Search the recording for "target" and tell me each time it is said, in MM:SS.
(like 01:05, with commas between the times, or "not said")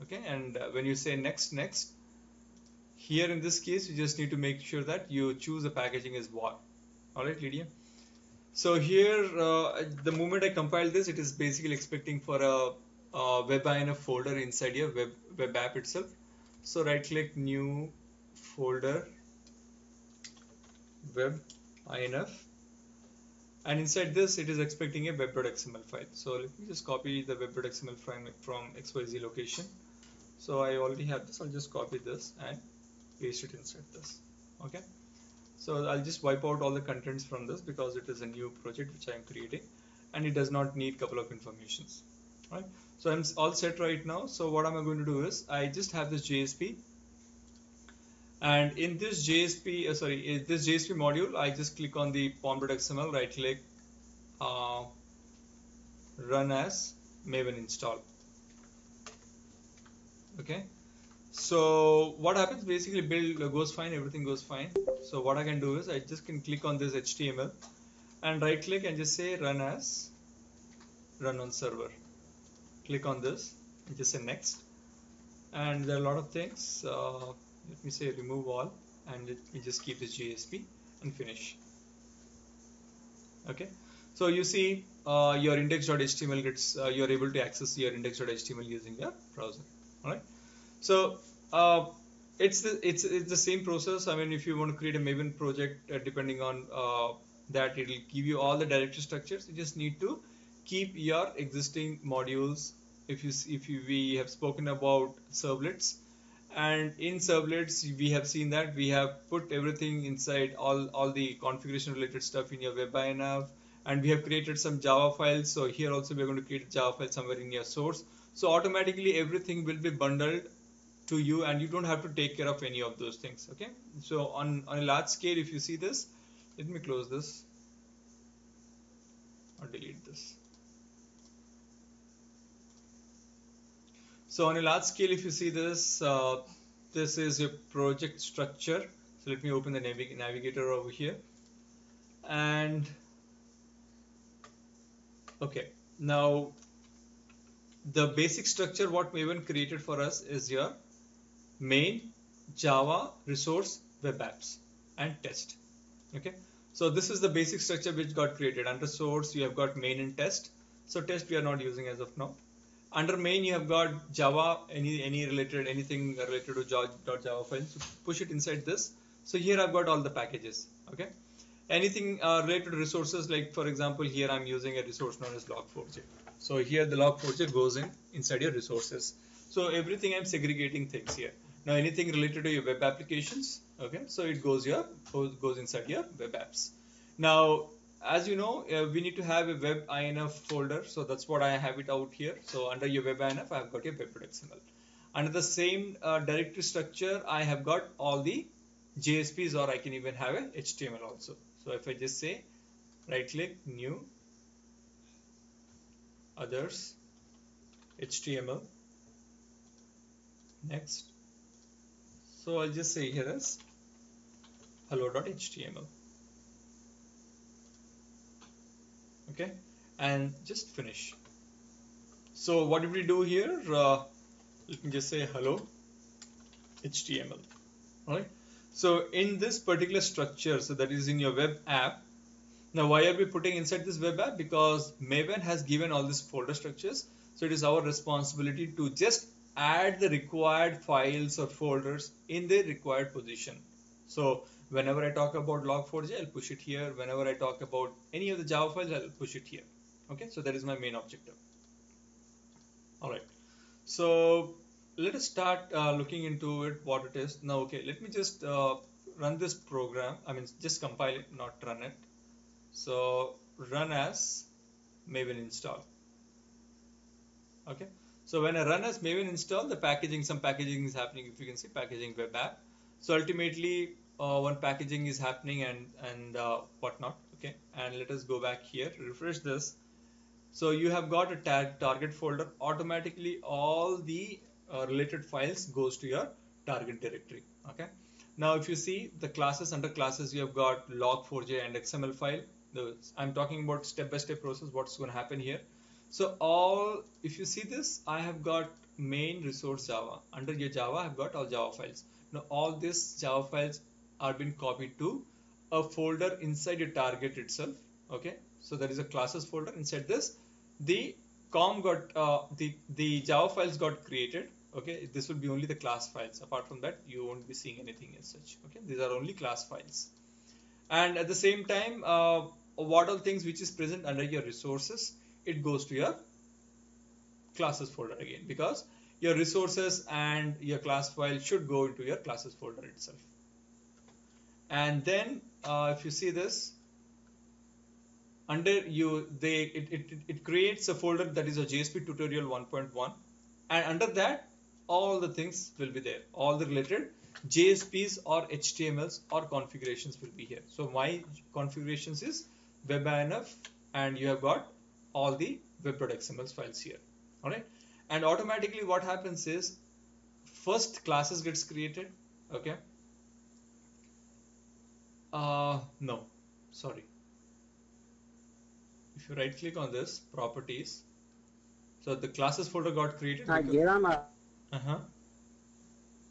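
04:41, 04:46, 05:06.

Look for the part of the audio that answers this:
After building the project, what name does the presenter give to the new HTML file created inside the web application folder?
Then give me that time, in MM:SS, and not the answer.
03:34.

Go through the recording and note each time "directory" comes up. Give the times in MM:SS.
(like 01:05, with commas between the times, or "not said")
01:38, 03:16, 04:47.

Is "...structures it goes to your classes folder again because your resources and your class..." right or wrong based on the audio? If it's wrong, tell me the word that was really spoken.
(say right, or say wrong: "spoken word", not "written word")
wrong: "resources", not "structures".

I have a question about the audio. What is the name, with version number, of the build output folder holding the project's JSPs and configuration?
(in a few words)
JSP tutorial 1.1.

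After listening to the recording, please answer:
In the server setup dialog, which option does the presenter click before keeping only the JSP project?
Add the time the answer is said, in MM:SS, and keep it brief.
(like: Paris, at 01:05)
remove all, at 01:18.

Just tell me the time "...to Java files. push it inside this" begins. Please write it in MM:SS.
02:46.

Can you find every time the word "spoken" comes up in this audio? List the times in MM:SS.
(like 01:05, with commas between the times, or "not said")
01:44.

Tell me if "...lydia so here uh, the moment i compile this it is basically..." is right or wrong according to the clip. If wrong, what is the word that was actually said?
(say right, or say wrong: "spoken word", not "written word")
right.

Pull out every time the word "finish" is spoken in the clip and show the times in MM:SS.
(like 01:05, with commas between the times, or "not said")
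01:21, 03:40.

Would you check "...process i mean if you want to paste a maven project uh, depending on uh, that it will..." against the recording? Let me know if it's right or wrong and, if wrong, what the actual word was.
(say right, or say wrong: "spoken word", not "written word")
wrong: "create", not "paste".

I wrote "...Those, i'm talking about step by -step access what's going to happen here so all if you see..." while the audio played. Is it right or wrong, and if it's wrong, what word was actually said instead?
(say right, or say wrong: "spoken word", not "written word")
wrong: "process", not "access".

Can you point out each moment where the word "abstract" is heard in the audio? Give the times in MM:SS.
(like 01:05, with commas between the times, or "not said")
not said.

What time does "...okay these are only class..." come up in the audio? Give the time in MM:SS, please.
05:18.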